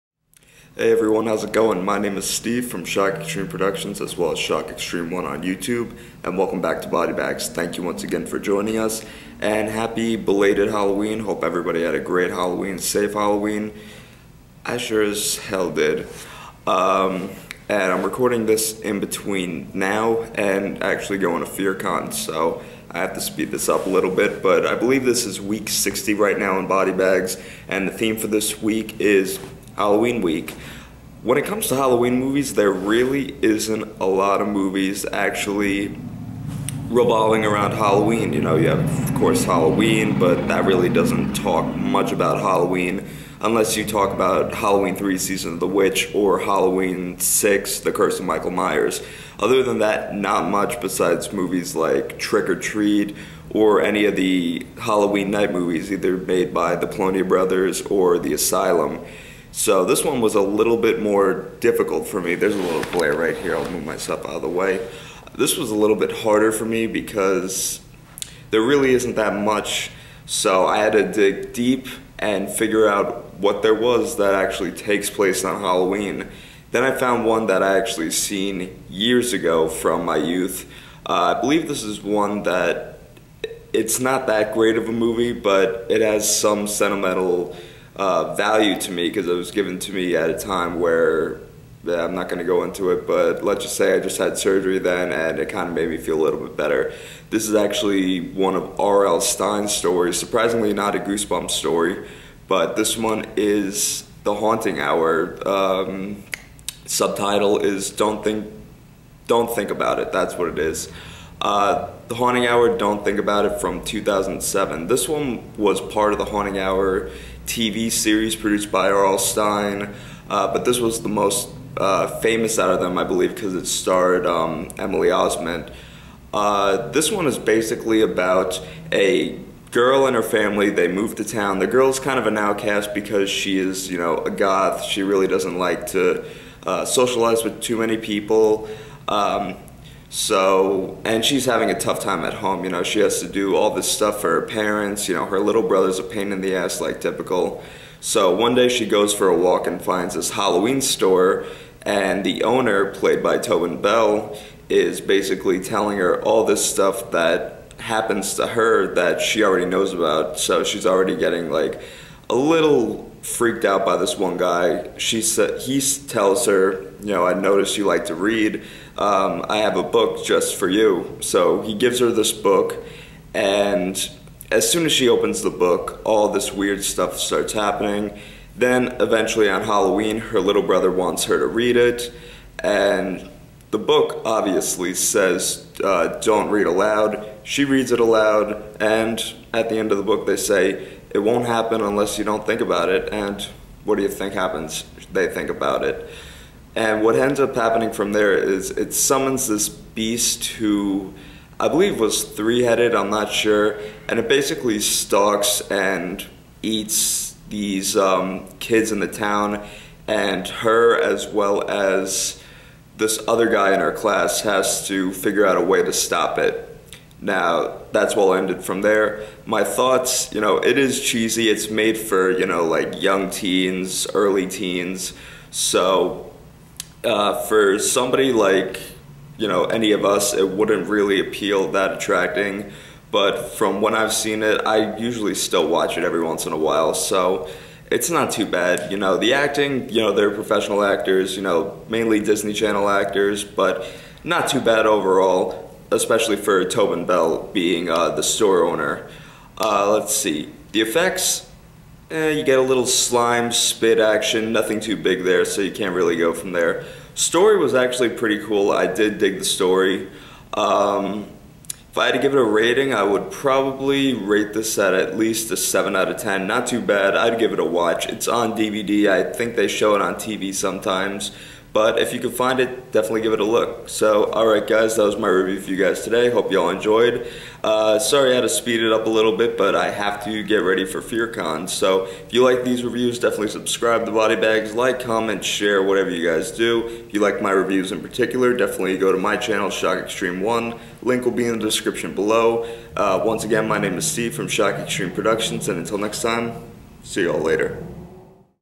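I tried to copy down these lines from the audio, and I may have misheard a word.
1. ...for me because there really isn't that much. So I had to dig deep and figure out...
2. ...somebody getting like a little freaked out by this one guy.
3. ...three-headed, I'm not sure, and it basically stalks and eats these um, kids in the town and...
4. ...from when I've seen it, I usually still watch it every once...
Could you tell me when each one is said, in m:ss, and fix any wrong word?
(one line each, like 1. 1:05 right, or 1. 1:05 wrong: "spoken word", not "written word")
1. 1:06 right
2. 2:40 wrong: "already", not "somebody"
3. 3:22 right
4. 3:53 right.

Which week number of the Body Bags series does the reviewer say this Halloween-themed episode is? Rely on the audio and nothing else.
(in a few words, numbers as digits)
60.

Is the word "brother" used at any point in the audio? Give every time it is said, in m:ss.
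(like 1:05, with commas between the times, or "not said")
0:57, 2:25, 3:00.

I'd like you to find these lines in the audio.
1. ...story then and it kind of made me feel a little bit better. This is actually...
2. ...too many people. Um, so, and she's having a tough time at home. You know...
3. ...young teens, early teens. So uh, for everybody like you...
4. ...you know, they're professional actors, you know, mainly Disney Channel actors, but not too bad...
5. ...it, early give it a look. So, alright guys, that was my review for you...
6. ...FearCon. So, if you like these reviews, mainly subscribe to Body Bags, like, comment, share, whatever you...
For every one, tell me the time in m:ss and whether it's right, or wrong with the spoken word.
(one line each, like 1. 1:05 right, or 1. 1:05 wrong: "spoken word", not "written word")
1. 1:34 wrong: "surgery", not "story"
2. 2:17 right
3. 3:42 wrong: "somebody", not "everybody"
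4. 3:59 right
5. 4:32 wrong: "definitely", not "early"
6. 4:41 wrong: "definitely", not "mainly".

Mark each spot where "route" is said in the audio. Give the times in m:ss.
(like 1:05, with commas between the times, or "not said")
not said.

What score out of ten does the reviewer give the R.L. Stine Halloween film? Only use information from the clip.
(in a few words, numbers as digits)
7.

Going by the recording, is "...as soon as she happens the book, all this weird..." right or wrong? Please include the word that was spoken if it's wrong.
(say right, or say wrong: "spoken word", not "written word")
wrong: "opens", not "happens".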